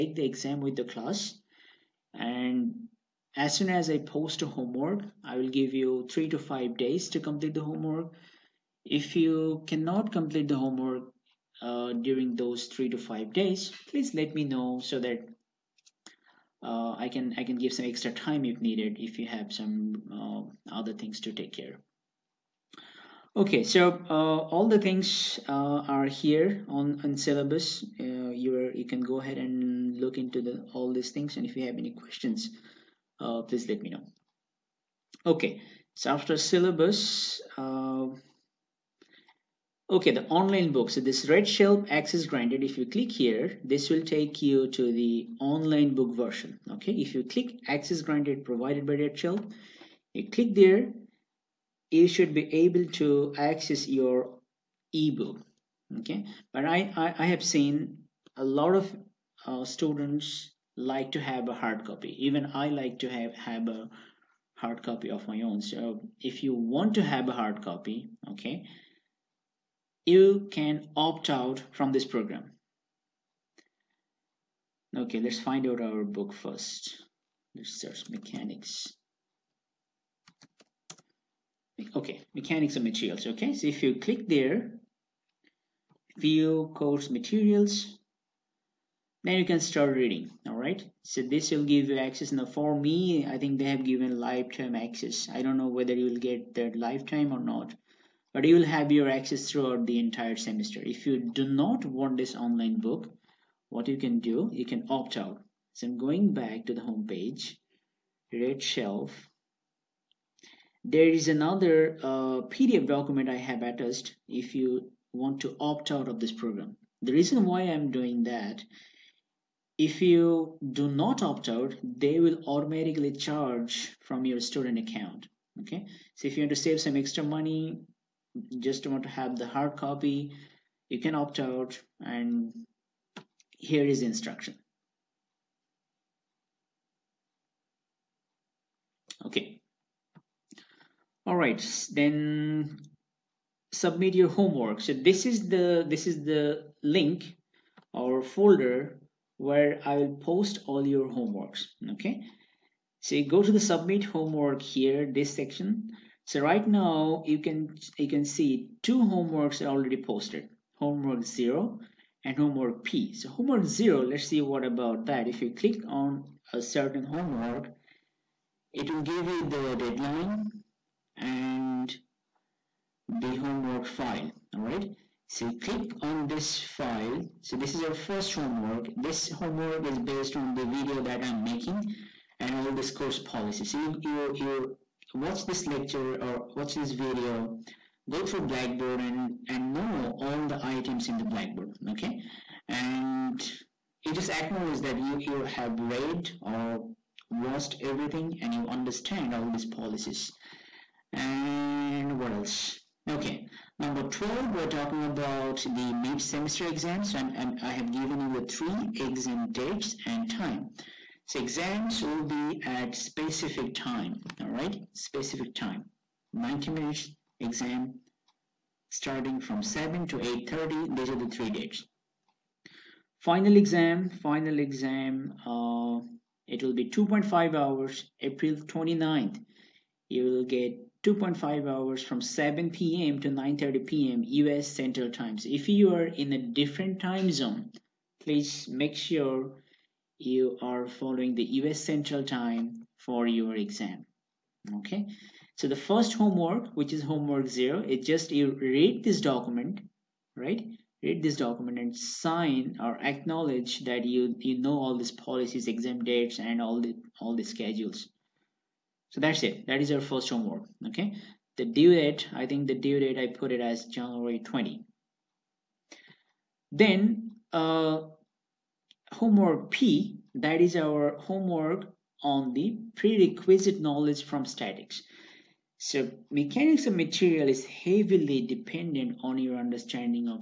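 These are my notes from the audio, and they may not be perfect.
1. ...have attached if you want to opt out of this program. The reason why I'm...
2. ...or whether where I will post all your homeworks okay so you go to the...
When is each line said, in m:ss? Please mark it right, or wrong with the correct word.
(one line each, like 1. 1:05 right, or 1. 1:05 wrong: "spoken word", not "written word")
1. 1:53 right
2. 2:27 wrong: "folder", not "whether".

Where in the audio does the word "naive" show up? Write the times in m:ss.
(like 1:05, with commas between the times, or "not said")
not said.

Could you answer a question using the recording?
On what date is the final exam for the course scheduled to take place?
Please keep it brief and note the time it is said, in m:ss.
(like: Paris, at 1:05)
April 29, at 3:48.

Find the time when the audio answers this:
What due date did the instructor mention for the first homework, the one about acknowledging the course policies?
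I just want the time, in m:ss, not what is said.
4:23.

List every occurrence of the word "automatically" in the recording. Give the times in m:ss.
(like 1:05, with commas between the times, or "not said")
2:02.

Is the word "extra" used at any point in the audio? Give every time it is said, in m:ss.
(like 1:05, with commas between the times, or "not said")
0:17, 2:06.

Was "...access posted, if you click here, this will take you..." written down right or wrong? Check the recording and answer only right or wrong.
wrong.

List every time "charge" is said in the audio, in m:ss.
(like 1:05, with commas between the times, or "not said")
2:03.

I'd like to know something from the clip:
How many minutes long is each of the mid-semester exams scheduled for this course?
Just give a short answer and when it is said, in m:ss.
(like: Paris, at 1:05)
90, at 3:36.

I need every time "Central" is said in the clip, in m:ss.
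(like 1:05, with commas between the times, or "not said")
3:54, 4:01.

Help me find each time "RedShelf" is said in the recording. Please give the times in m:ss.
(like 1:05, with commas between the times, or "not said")
0:41, 0:48, 1:48.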